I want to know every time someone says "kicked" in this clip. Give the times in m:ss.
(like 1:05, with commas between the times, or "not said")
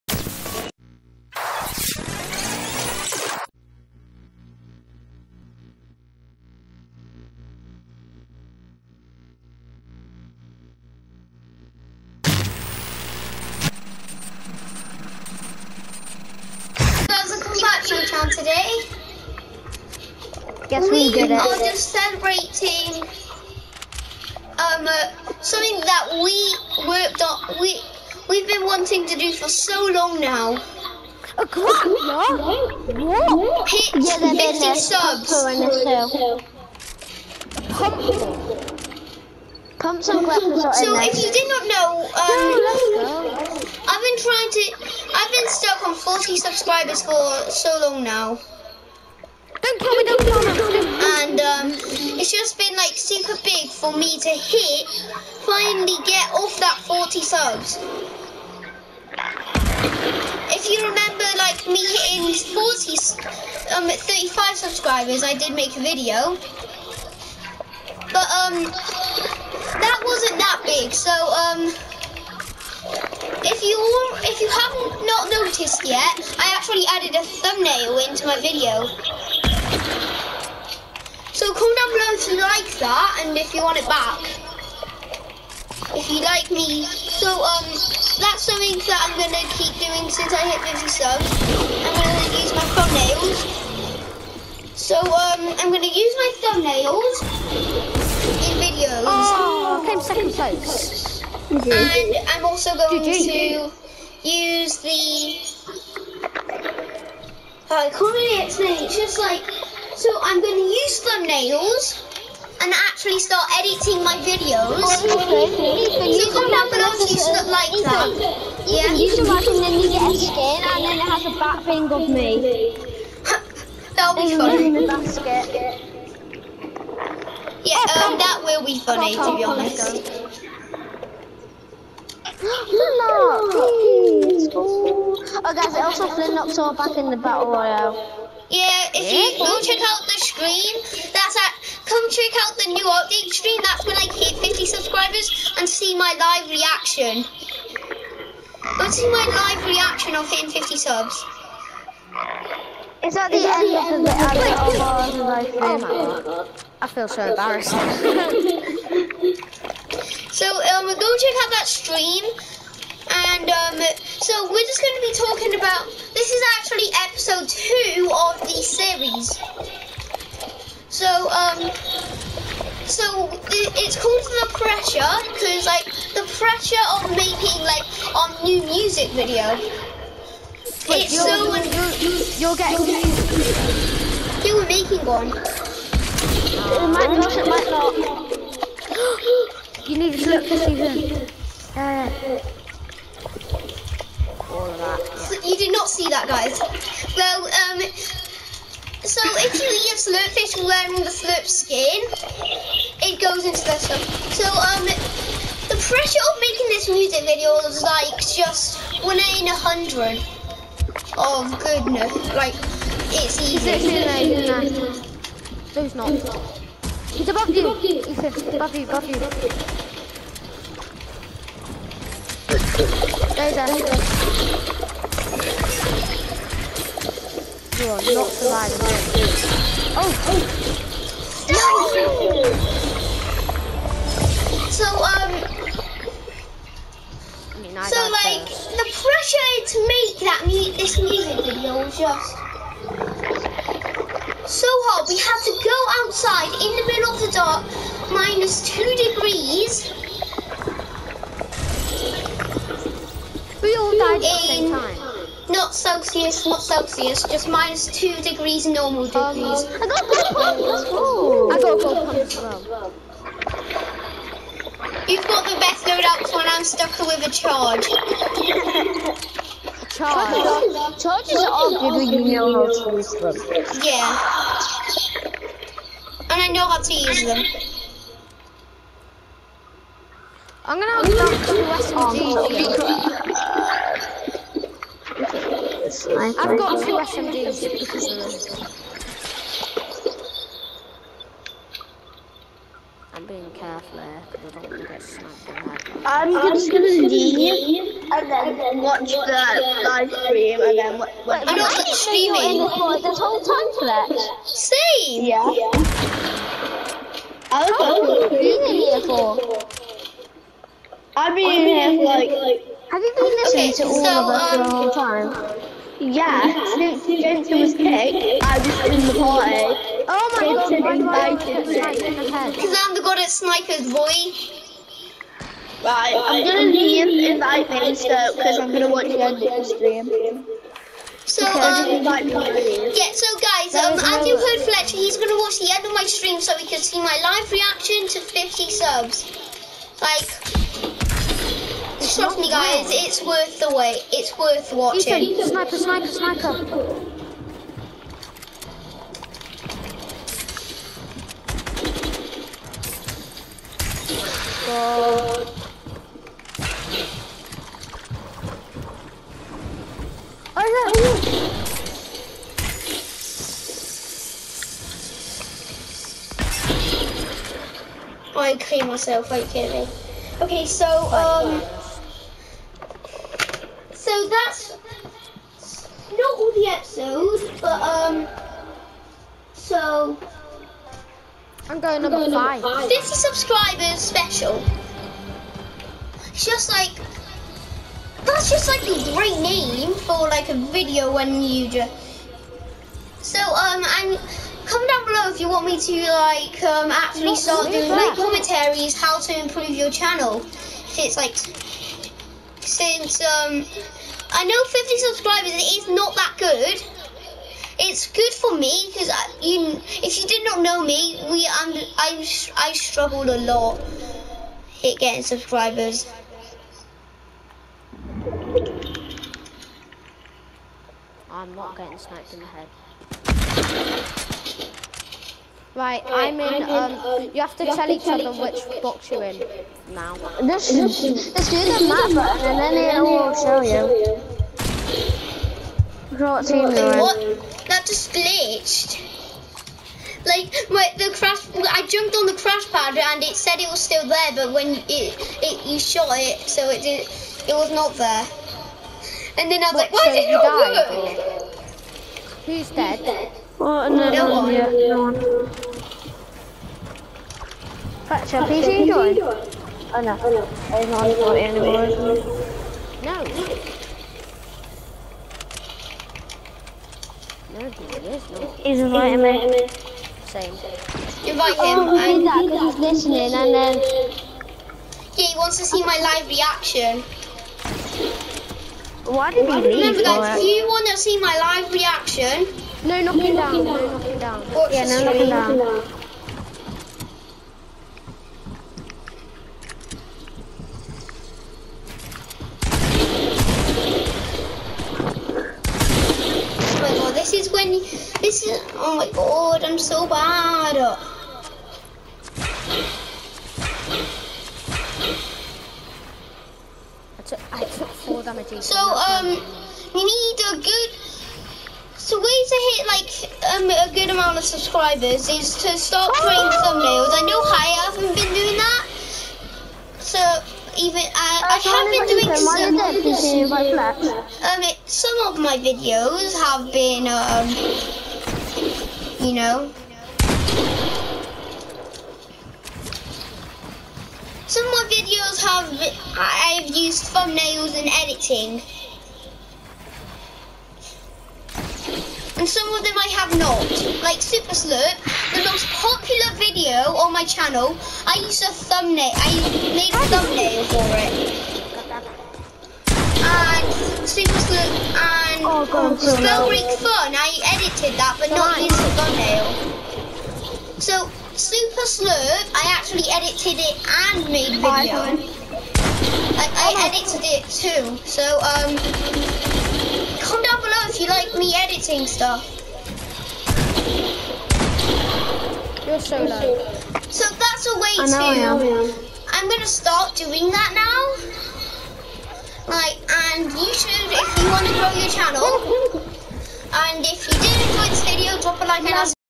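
5:17.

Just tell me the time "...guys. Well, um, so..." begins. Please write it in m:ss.
3:16.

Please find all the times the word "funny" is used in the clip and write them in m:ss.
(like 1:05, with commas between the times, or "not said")
2:04, 2:08.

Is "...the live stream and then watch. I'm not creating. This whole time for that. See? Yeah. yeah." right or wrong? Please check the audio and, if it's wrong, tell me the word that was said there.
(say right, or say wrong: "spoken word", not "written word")
wrong: "streaming", not "creating".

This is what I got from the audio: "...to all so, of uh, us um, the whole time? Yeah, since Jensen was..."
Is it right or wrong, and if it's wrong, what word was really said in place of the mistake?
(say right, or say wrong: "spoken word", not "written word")
right.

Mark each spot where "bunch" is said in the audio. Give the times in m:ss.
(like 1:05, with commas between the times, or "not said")
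not said.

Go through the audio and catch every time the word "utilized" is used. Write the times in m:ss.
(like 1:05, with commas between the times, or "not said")
not said.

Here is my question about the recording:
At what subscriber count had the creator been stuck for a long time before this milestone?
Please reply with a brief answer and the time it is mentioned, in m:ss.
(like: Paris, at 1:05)
40, at 0:45.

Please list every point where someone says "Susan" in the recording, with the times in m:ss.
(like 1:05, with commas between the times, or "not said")
3:10.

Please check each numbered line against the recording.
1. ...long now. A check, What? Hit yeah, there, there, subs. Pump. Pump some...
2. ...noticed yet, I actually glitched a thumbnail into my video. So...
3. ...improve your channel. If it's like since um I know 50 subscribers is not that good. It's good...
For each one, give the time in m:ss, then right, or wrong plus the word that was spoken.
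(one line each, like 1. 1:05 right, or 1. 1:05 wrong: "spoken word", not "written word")
1. 0:29 wrong: "clock", not "check"
2. 1:15 wrong: "added", not "glitched"
3. 6:39 right.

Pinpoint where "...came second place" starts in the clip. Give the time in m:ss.
1:39.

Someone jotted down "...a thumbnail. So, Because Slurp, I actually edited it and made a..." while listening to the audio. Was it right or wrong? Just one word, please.
wrong.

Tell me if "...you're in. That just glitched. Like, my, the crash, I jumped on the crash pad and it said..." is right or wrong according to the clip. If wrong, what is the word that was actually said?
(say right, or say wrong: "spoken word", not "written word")
right.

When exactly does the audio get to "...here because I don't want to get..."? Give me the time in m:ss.
4:54.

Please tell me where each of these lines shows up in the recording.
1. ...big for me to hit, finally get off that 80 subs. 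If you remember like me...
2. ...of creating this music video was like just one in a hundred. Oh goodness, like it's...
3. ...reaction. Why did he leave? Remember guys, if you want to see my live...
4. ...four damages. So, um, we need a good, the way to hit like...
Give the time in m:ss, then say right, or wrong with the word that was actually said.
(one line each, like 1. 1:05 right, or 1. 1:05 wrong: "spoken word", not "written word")
1. 0:53 wrong: "40", not "80"
2. 3:26 wrong: "making", not "creating"
3. 7:56 right
4. 8:27 right.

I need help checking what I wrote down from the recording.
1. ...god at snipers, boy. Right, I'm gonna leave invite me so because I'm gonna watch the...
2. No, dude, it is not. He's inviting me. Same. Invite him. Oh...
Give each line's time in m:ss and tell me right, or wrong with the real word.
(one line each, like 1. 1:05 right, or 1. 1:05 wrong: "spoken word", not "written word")
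1. 5:23 right
2. 7:47 right.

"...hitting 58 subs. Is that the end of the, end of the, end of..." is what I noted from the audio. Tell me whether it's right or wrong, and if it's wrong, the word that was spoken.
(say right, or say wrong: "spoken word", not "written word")
wrong: "50", not "58".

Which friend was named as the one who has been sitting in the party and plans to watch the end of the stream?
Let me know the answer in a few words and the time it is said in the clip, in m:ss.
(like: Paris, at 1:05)
Fletcher, at 5:34.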